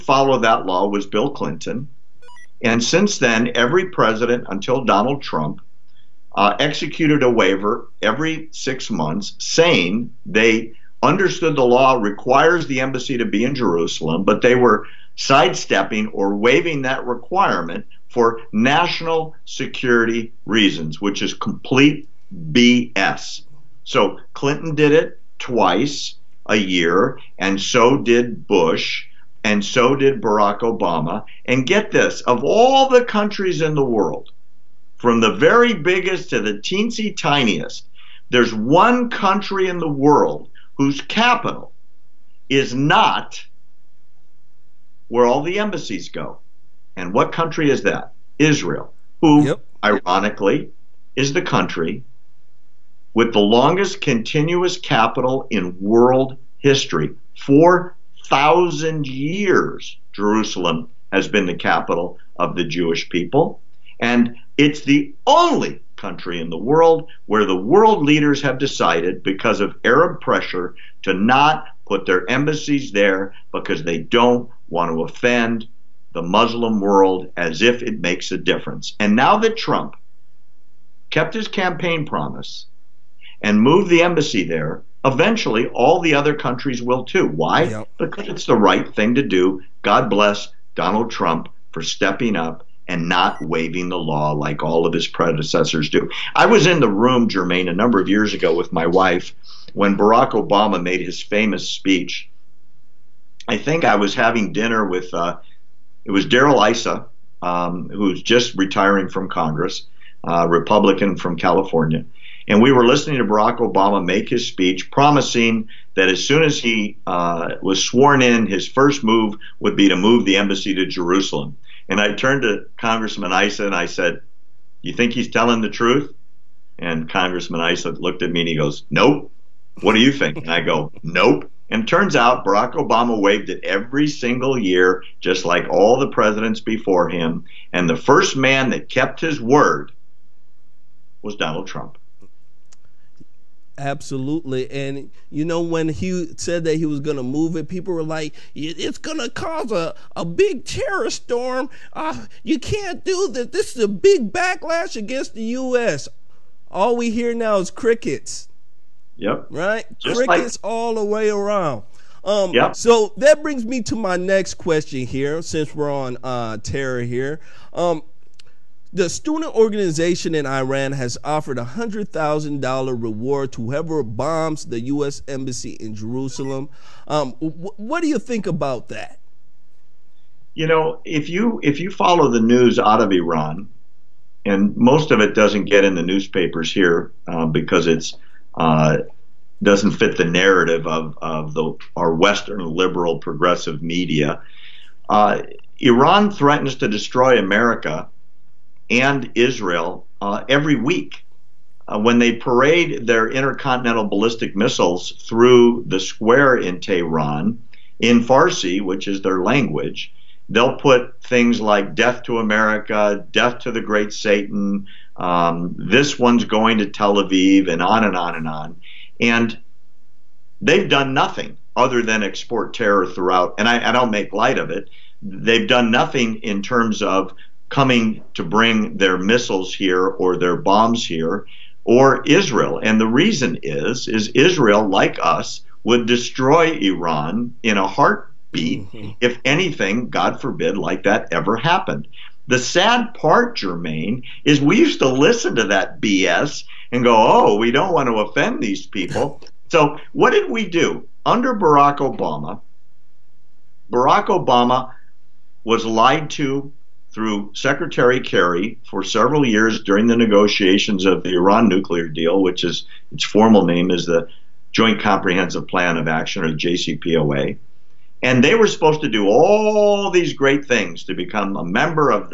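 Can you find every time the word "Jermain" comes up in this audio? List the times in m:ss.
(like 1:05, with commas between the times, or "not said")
1:37, 4:03.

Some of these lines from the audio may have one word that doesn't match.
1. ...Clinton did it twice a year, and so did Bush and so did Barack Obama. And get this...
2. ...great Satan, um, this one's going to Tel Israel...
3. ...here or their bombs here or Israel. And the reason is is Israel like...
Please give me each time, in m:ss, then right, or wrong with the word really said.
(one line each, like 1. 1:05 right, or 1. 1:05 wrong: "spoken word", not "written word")
1. 0:24 right
2. 3:33 wrong: "Aviv", not "Israel"
3. 3:49 right.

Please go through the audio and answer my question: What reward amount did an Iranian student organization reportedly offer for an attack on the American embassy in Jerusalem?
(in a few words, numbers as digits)
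$100,000.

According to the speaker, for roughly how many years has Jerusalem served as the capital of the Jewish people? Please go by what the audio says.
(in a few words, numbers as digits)
4000 years.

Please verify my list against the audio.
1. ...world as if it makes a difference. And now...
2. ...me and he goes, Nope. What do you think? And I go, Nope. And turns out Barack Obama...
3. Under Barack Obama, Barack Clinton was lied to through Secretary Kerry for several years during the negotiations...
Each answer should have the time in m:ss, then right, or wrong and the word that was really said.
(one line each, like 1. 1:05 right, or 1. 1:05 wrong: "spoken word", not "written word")
1. 1:16 right
2. 2:08 right
3. 4:11 wrong: "Obama", not "Clinton".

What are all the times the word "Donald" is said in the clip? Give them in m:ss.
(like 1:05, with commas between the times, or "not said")
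0:04, 1:30, 2:21.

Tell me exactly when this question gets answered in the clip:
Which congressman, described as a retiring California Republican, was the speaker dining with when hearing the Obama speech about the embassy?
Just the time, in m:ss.
1:46.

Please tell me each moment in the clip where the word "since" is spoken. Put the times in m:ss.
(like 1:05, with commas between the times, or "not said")
0:02, 2:45.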